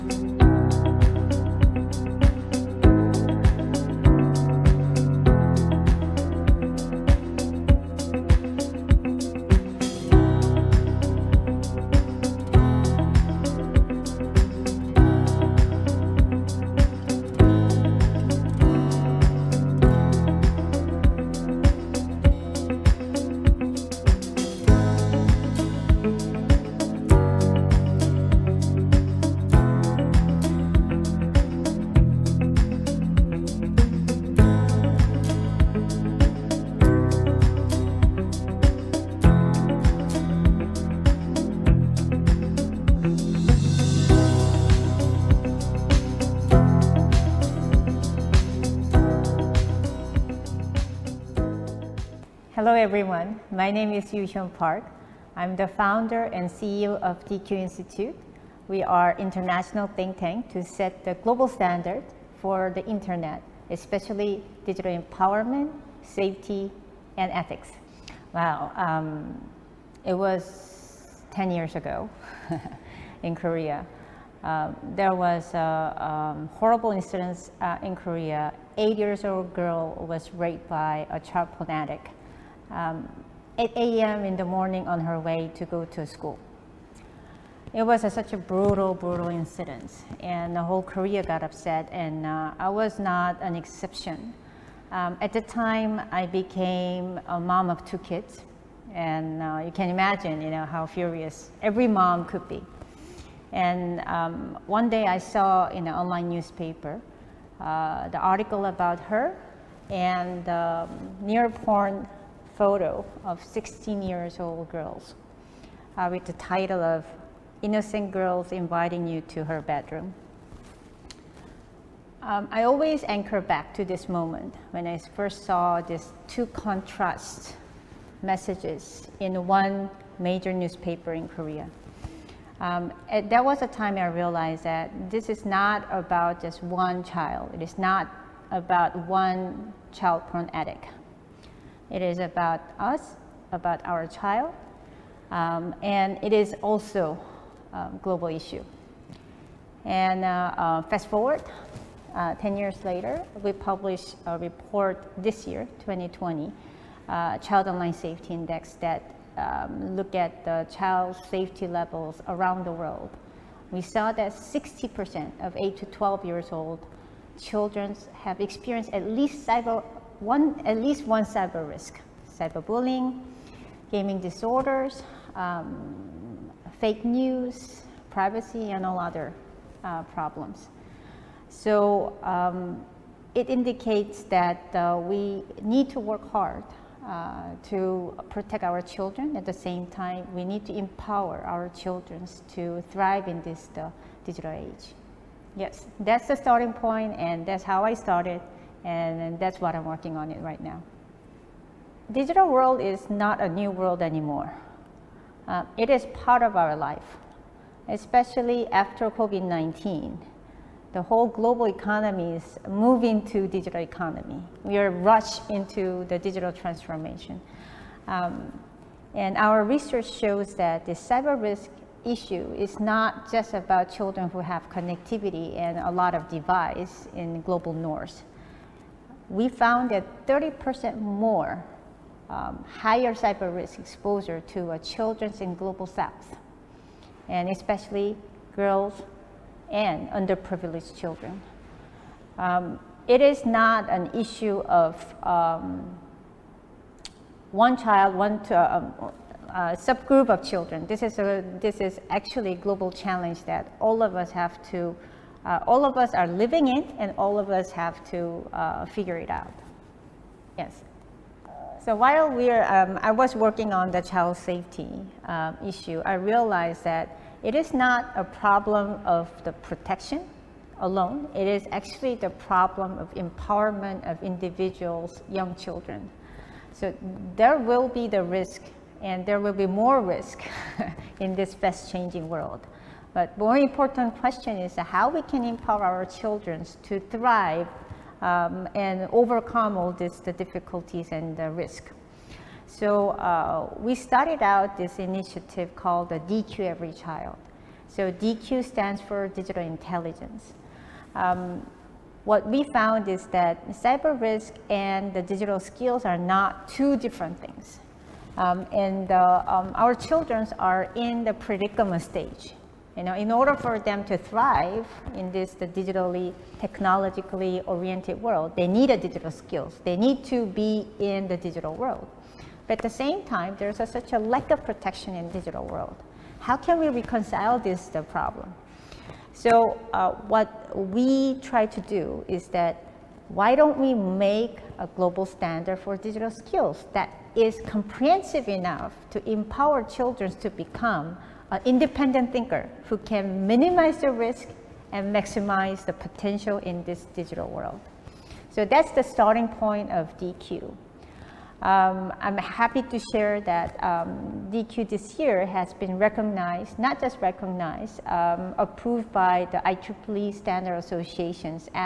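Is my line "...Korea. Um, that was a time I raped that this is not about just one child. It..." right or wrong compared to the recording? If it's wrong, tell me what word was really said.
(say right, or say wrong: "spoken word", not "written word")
wrong: "realized", not "raped".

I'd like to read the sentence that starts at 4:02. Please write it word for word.
Um, it is not an issue of um, one child, one to, uh, uh, subgroup of children.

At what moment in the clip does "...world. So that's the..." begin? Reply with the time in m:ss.
5:47.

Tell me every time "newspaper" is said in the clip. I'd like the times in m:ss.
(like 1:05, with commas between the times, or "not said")
1:46, 2:10.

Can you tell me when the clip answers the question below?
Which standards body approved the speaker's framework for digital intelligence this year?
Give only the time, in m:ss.
5:59.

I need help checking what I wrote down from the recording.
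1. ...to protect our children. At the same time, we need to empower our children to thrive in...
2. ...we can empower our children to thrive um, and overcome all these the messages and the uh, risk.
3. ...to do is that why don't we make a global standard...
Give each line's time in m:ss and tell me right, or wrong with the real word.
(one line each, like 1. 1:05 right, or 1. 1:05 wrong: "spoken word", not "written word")
1. 3:07 right
2. 4:45 wrong: "difficulties", not "messages"
3. 5:31 right.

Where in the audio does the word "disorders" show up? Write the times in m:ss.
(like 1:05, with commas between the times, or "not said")
2:54.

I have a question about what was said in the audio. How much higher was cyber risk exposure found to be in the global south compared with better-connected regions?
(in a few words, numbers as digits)
30%.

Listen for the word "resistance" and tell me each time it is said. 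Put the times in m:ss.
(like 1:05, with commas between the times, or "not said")
not said.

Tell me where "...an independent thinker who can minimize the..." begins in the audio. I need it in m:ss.
5:41.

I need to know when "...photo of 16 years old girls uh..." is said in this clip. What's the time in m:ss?
1:52.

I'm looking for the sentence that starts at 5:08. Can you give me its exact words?
Um, and uh, um, our children are in the predicament stage.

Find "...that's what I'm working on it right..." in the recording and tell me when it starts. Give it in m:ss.
3:19.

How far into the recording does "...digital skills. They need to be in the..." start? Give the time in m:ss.
5:18.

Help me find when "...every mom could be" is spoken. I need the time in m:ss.
1:41.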